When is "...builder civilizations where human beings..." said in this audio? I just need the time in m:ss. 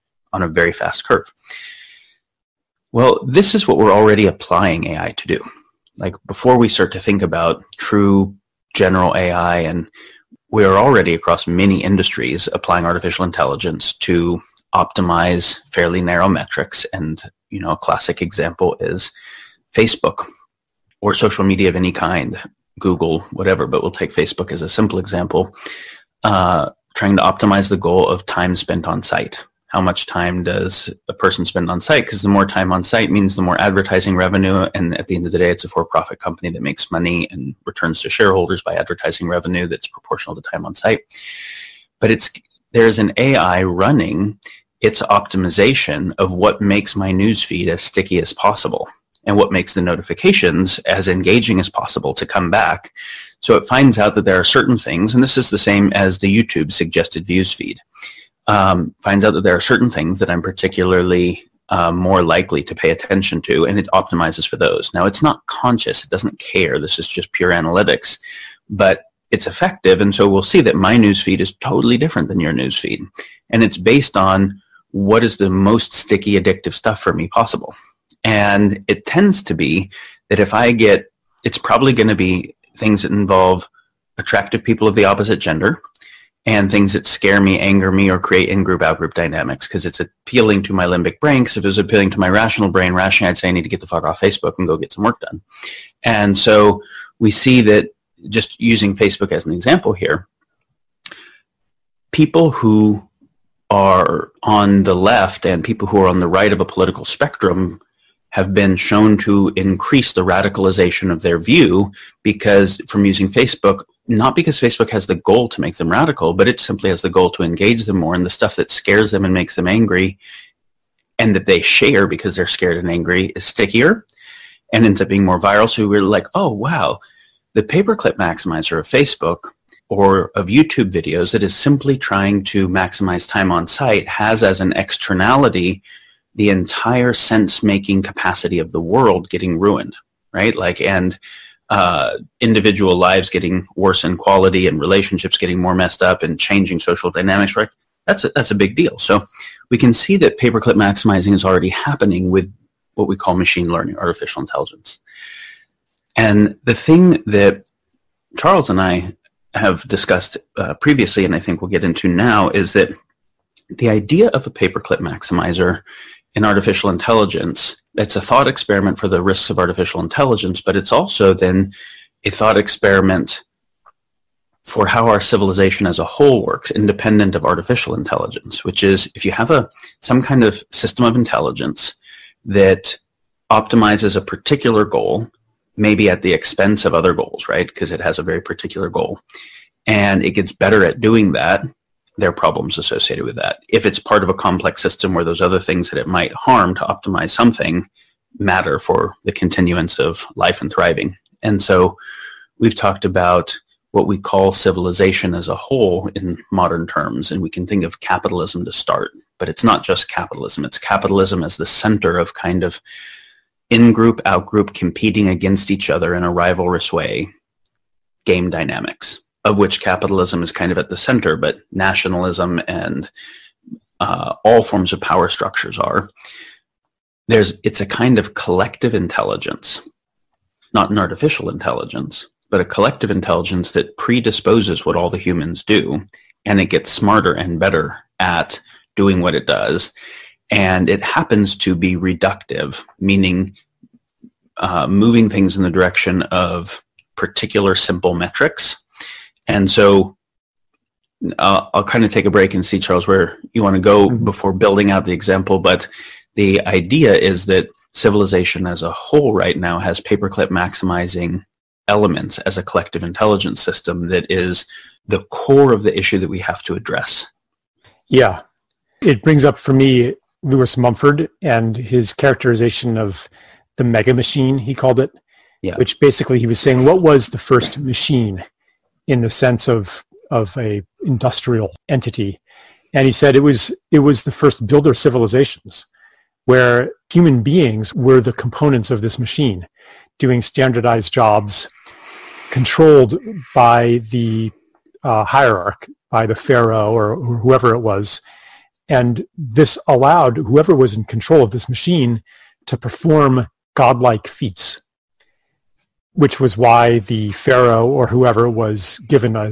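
4:44.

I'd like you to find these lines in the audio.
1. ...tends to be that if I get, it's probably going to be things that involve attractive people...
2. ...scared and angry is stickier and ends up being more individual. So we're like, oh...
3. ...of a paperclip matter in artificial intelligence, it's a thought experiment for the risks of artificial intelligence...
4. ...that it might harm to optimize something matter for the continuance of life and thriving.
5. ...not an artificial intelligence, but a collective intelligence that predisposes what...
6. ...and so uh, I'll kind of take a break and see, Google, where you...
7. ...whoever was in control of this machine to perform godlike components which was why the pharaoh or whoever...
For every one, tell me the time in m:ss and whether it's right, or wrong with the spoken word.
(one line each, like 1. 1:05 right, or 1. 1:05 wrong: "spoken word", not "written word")
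1. 1:19 right
2. 2:02 wrong: "viral", not "individual"
3. 2:44 wrong: "maximizer", not "matter"
4. 3:15 right
5. 3:50 right
6. 4:09 wrong: "Charles", not "Google"
7. 5:00 wrong: "feats", not "components".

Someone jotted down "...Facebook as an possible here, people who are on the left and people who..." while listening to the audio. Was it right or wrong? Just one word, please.
wrong.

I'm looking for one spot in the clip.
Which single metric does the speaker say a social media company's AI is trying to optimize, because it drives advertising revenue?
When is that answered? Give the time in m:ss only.
0:28.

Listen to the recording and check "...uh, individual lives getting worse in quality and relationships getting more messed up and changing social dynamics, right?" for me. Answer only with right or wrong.
right.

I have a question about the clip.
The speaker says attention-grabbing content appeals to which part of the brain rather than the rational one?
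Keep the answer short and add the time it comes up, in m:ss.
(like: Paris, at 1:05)
Limbic brain, at 1:30.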